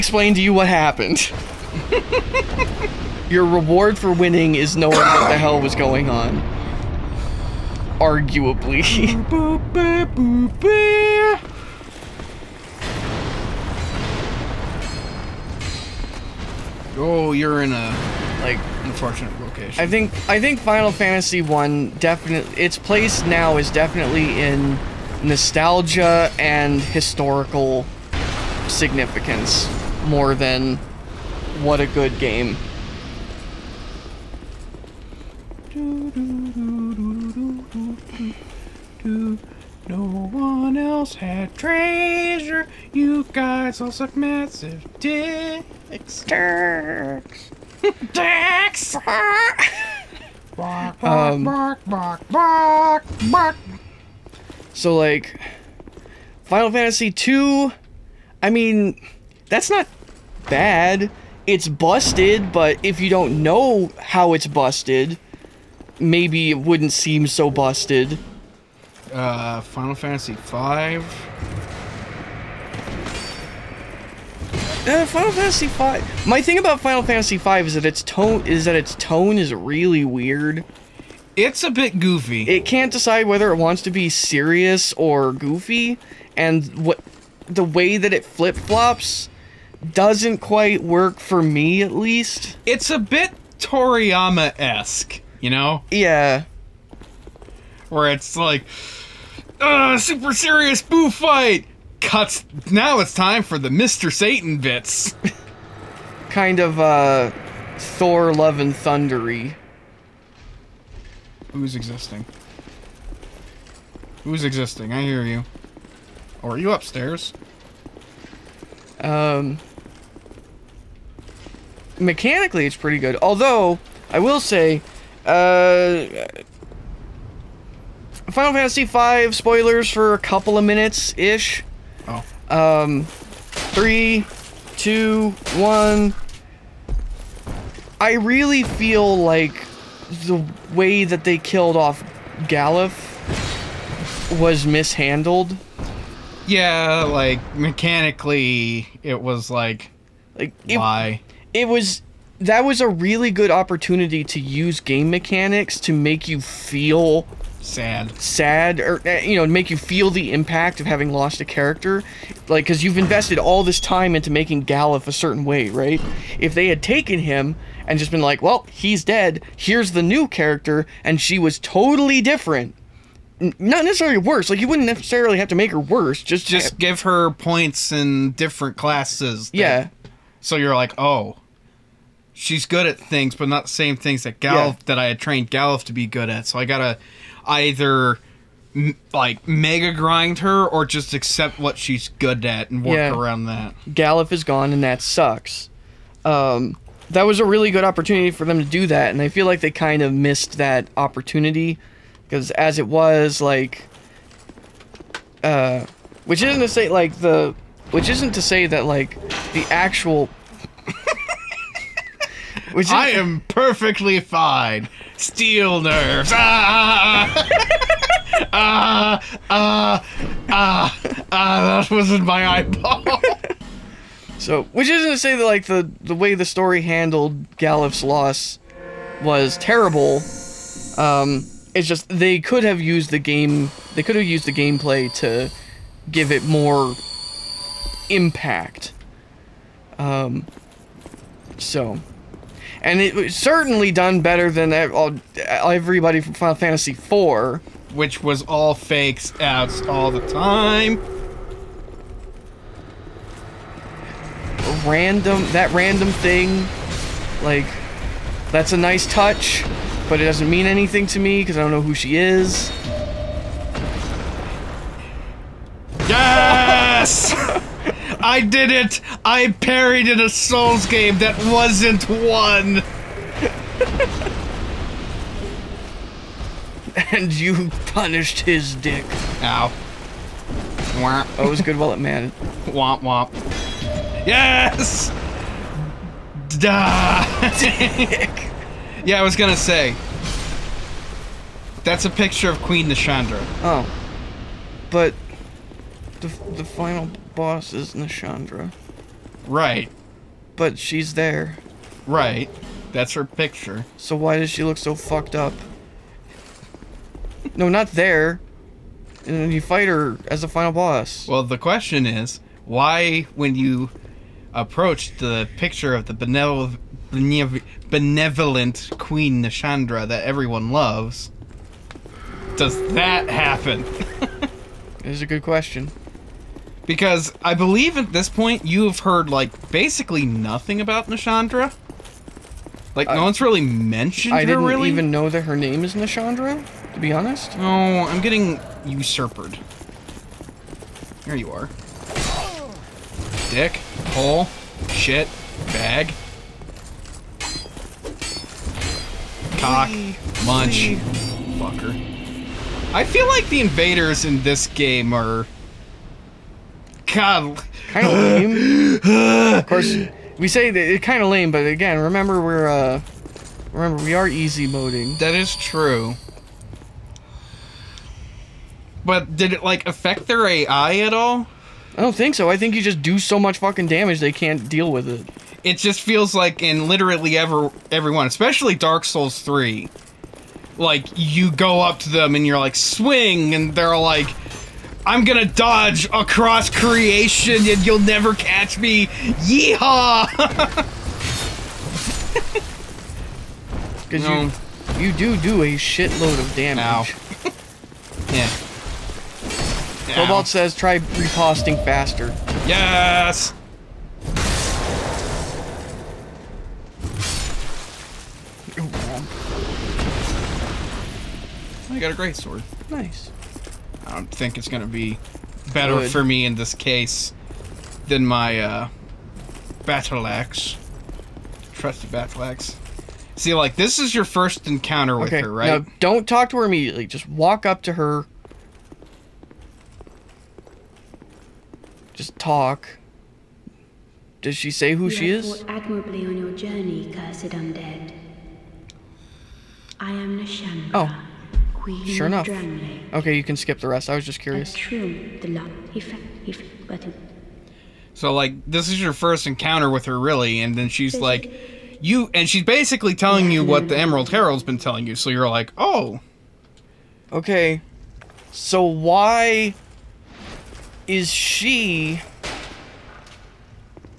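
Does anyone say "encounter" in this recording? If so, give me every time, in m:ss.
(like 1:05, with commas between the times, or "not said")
7:04, 7:29.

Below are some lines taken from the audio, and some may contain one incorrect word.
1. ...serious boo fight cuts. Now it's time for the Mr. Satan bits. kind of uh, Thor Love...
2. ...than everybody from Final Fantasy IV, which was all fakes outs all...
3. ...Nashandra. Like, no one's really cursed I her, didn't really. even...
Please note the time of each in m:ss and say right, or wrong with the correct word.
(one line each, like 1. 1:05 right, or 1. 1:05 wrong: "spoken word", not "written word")
1. 1:40 right
2. 4:04 right
3. 5:31 wrong: "mentioned", not "cursed".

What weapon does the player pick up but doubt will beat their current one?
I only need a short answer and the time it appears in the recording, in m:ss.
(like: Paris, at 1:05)
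great sword, at 6:52.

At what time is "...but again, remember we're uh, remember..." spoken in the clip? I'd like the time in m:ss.
6:01.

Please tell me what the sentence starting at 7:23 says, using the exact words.
Okay, you can skip the rest.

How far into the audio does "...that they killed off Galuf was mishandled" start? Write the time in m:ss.
2:21.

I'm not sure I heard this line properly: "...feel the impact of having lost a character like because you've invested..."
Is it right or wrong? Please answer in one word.
right.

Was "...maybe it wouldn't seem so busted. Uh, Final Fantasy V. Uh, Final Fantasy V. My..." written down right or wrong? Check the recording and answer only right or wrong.
right.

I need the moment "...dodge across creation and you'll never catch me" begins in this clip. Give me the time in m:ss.
6:25.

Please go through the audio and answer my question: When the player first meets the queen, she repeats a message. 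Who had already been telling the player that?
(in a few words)
Emerald Herald.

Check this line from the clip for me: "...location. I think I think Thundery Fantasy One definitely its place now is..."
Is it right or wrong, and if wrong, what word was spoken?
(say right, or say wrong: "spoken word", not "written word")
wrong: "Final", not "Thundery".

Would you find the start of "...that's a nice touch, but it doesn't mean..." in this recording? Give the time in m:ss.
4:18.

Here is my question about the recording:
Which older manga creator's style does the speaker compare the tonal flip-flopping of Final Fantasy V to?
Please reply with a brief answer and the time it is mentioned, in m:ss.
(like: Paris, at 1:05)
Toriyama, at 1:33.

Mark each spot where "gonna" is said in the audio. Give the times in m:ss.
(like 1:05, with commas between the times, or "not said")
4:49, 6:25.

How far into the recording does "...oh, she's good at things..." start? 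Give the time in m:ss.
3:00.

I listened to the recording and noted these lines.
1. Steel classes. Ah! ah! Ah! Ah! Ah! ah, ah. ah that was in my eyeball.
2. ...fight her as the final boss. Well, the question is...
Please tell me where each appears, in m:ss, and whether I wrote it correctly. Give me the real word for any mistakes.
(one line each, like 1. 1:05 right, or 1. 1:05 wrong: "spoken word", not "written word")
1. 3:35 wrong: "nerves", not "classes"
2. 5:09 right.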